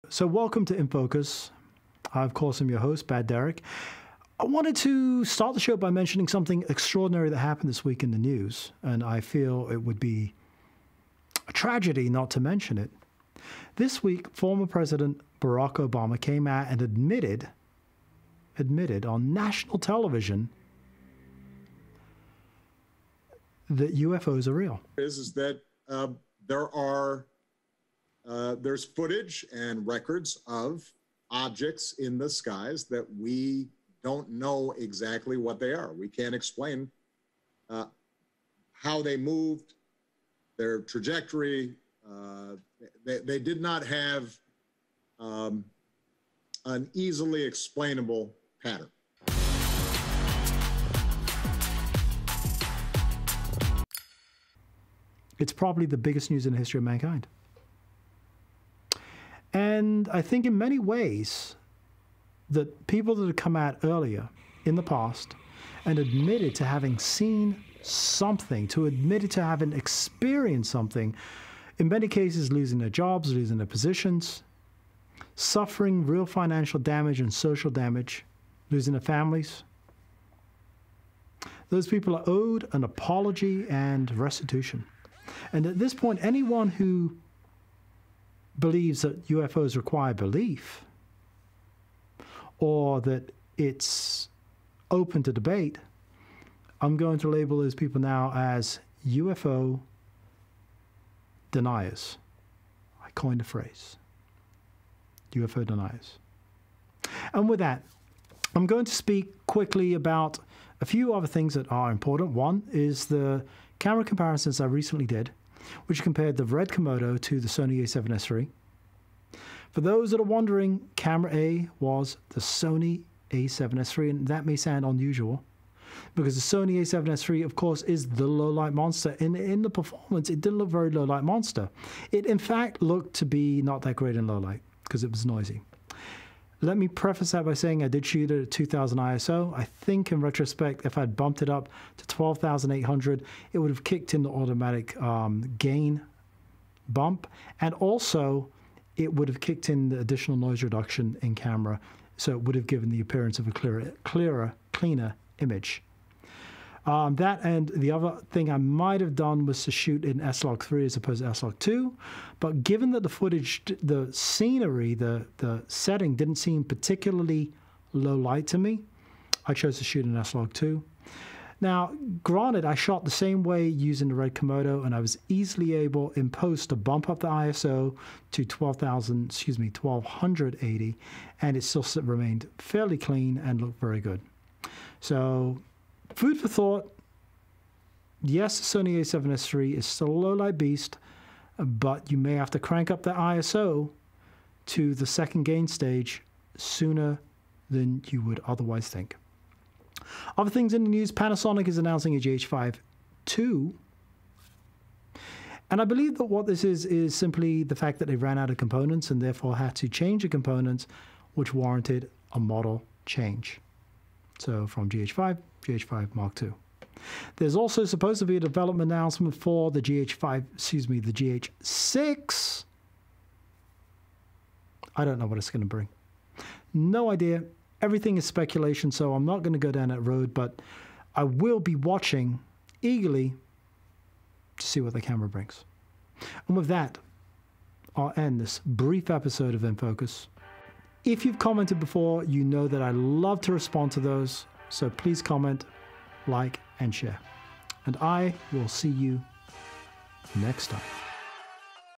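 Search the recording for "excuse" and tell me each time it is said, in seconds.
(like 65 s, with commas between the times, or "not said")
179 s, 220 s.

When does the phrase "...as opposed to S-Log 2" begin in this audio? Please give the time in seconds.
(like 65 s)
160 s.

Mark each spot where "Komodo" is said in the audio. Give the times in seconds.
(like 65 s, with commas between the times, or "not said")
116 s, 174 s.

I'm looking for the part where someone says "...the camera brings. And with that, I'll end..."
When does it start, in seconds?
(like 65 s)
234 s.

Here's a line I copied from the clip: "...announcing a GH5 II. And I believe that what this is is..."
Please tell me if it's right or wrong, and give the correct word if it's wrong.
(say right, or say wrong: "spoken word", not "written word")
right.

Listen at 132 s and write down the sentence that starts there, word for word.
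It, in fact, looked to be not that great in low light because it was noisy.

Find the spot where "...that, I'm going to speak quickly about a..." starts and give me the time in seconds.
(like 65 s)
107 s.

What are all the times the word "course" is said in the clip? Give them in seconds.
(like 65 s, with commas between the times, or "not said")
2 s, 127 s.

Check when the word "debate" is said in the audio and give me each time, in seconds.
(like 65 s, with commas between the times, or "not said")
95 s.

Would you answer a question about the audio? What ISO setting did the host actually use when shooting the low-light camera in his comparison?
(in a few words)
2000.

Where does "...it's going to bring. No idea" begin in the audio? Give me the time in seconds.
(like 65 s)
225 s.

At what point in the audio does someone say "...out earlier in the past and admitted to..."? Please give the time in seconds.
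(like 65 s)
63 s.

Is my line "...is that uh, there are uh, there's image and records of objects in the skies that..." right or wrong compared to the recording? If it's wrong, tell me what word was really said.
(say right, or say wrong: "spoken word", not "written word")
wrong: "footage", not "image".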